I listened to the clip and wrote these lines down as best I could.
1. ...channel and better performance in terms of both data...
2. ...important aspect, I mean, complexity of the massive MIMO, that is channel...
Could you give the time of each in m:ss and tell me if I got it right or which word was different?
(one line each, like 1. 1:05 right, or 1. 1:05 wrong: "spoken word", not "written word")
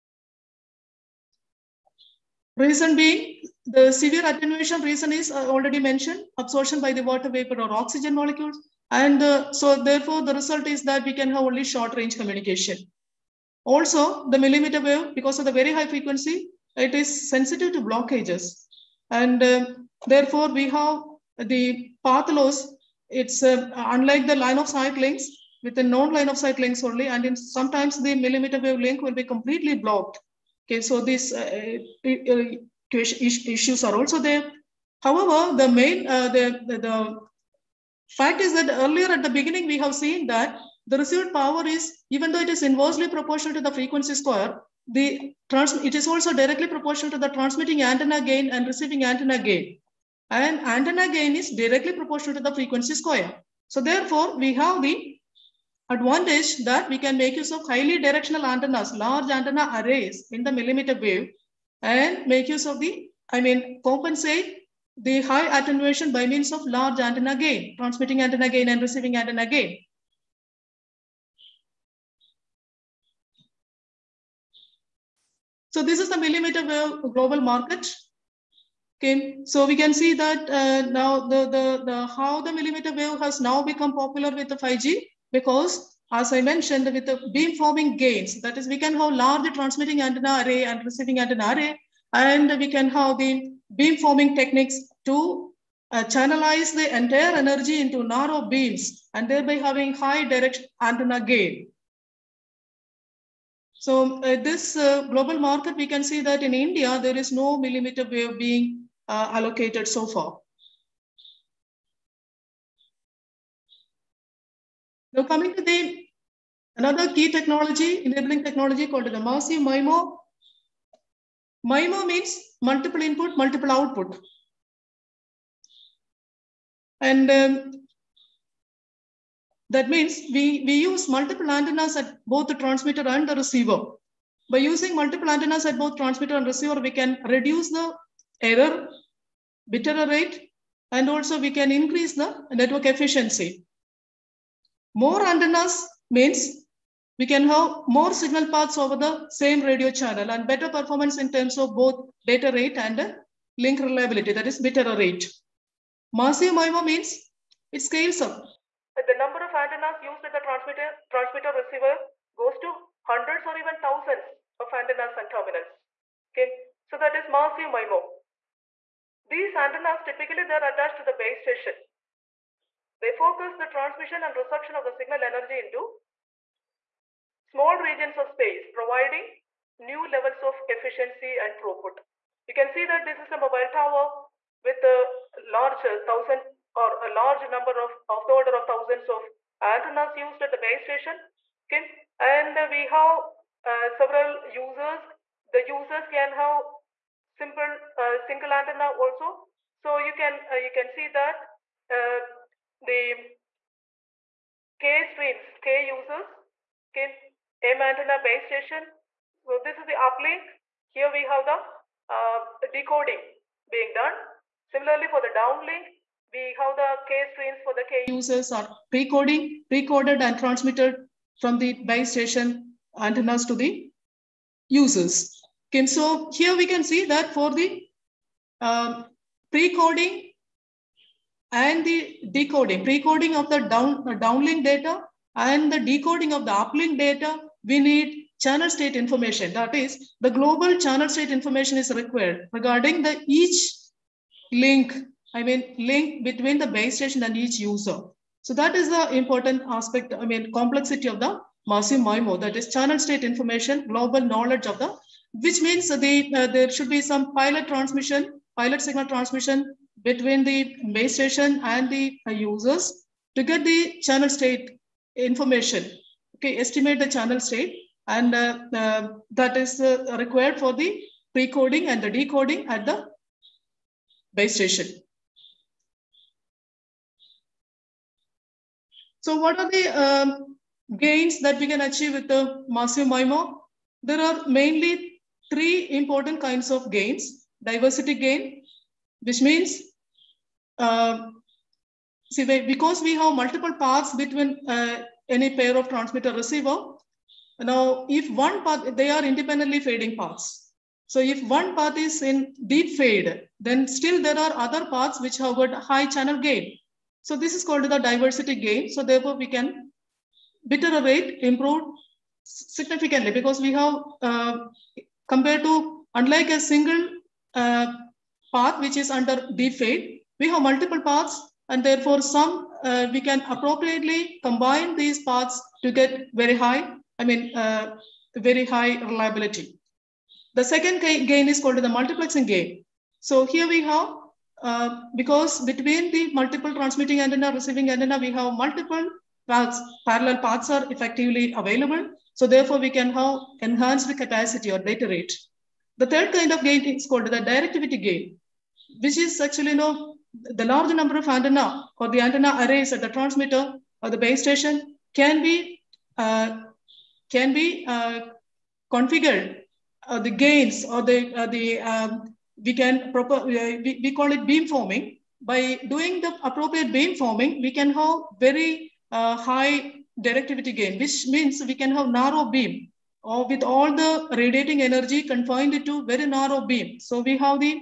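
1. 2:29 right
2. 4:09 right.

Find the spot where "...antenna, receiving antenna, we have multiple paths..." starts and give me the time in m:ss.
5:37.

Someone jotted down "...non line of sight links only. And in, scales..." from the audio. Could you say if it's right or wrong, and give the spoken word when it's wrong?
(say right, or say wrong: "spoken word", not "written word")
wrong: "sometimes", not "scales".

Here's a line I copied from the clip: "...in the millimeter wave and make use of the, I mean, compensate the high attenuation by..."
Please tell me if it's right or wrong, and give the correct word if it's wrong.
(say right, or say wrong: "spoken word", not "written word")
right.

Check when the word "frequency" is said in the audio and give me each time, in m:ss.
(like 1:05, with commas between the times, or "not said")
0:15, 0:43, 0:52.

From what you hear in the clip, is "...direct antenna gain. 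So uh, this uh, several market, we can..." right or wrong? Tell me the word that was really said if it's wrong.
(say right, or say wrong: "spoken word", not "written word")
wrong: "global", not "several".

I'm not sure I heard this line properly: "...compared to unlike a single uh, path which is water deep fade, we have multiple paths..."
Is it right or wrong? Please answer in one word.
wrong.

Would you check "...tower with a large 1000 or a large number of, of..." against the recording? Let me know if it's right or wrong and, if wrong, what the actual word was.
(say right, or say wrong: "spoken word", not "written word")
right.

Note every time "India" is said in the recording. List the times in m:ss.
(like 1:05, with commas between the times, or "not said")
1:46.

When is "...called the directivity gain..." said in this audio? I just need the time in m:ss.
5:47.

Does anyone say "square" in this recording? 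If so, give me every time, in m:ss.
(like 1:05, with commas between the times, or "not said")
0:44, 0:52.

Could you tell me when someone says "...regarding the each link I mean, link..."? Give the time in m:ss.
4:02.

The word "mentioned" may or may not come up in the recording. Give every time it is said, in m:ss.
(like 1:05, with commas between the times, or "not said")
0:05, 1:26.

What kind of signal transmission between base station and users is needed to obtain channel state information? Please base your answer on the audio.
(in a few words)
pilot signal.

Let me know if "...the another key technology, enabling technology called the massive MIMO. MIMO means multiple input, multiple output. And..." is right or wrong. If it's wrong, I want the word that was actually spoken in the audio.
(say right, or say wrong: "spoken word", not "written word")
right.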